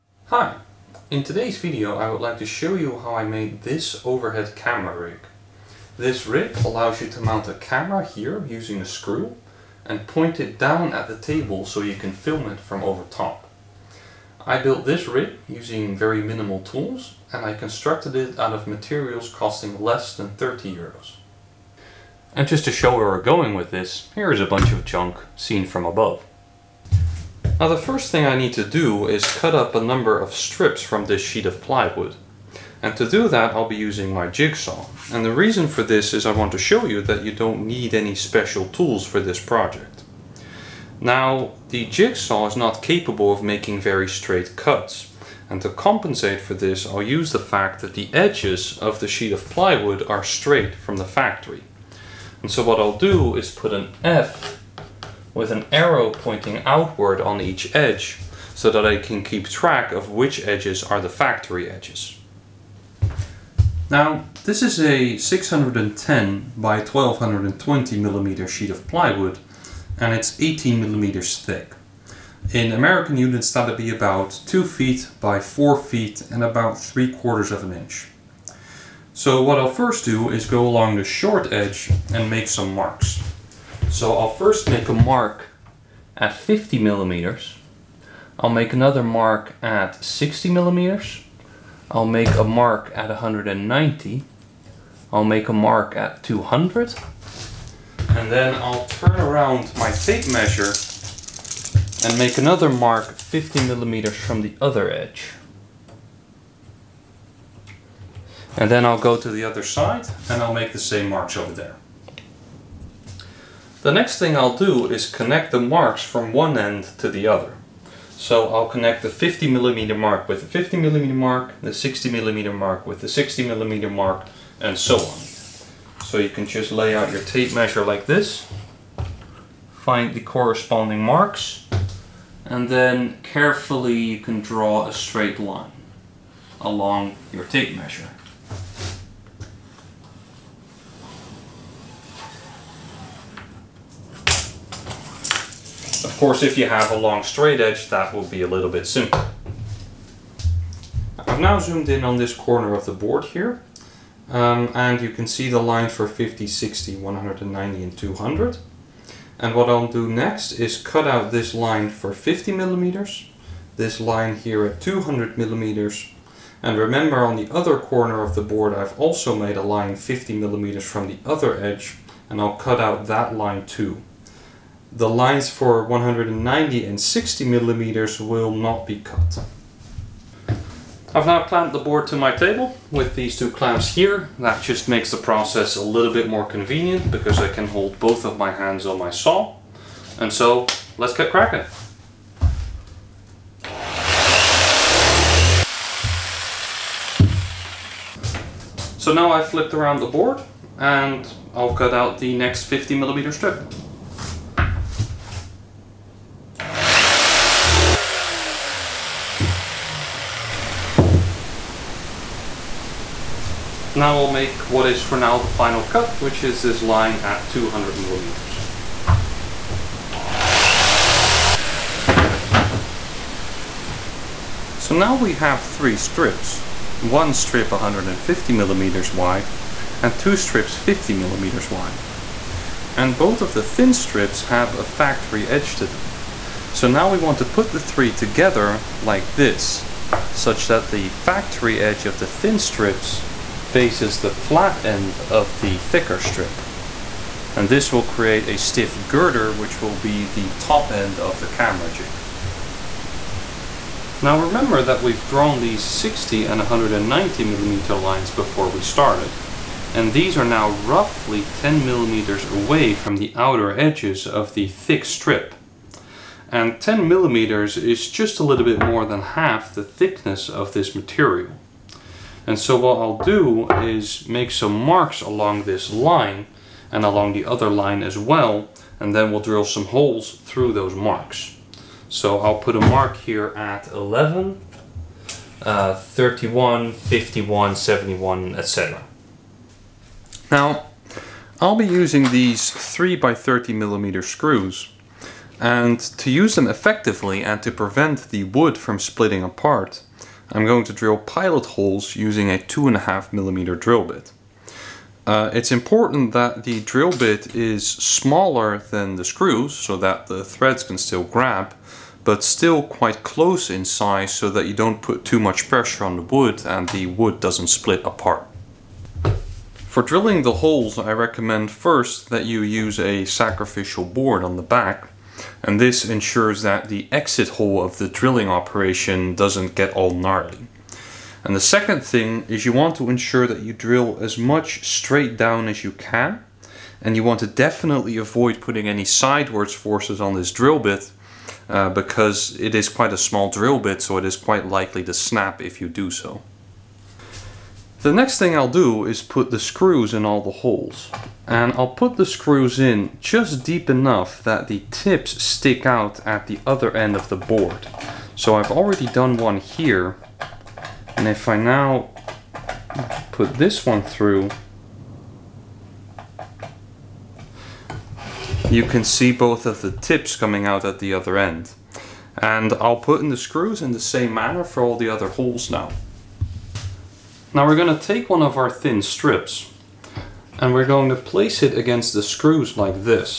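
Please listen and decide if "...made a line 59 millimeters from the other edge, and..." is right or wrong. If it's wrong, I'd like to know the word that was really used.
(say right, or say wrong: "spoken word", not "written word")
wrong: "50", not "59".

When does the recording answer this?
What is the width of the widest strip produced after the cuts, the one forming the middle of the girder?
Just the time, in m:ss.
3:47.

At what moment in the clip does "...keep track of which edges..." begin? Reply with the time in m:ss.
0:59.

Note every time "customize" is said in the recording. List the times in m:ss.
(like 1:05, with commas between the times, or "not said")
not said.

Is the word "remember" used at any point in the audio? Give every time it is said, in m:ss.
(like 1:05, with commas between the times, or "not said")
2:46, 4:14.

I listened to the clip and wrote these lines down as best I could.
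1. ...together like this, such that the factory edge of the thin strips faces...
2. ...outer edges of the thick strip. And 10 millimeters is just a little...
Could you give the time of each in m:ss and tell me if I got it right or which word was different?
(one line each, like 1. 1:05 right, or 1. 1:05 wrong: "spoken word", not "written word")
1. 3:58 right
2. 4:23 right.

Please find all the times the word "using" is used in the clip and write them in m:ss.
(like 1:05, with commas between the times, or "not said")
0:08, 0:15, 0:33, 4:51, 5:02.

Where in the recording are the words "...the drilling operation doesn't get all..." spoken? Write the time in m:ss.
5:27.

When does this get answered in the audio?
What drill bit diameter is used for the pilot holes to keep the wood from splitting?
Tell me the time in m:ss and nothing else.
5:02.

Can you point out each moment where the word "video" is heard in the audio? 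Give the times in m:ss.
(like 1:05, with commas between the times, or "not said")
0:01.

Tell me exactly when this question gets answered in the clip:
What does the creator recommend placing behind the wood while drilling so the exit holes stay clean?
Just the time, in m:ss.
5:23.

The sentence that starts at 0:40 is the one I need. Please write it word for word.
Now the jigsaw is not capable of making very straight cuts.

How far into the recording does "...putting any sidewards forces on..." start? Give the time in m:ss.
5:38.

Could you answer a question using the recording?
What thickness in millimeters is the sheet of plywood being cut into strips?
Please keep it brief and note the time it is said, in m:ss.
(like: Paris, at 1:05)
18 millimeters, at 1:10.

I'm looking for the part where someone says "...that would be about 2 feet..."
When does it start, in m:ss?
1:13.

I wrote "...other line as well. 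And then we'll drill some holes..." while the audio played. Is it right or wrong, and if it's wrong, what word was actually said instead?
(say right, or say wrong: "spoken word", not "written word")
right.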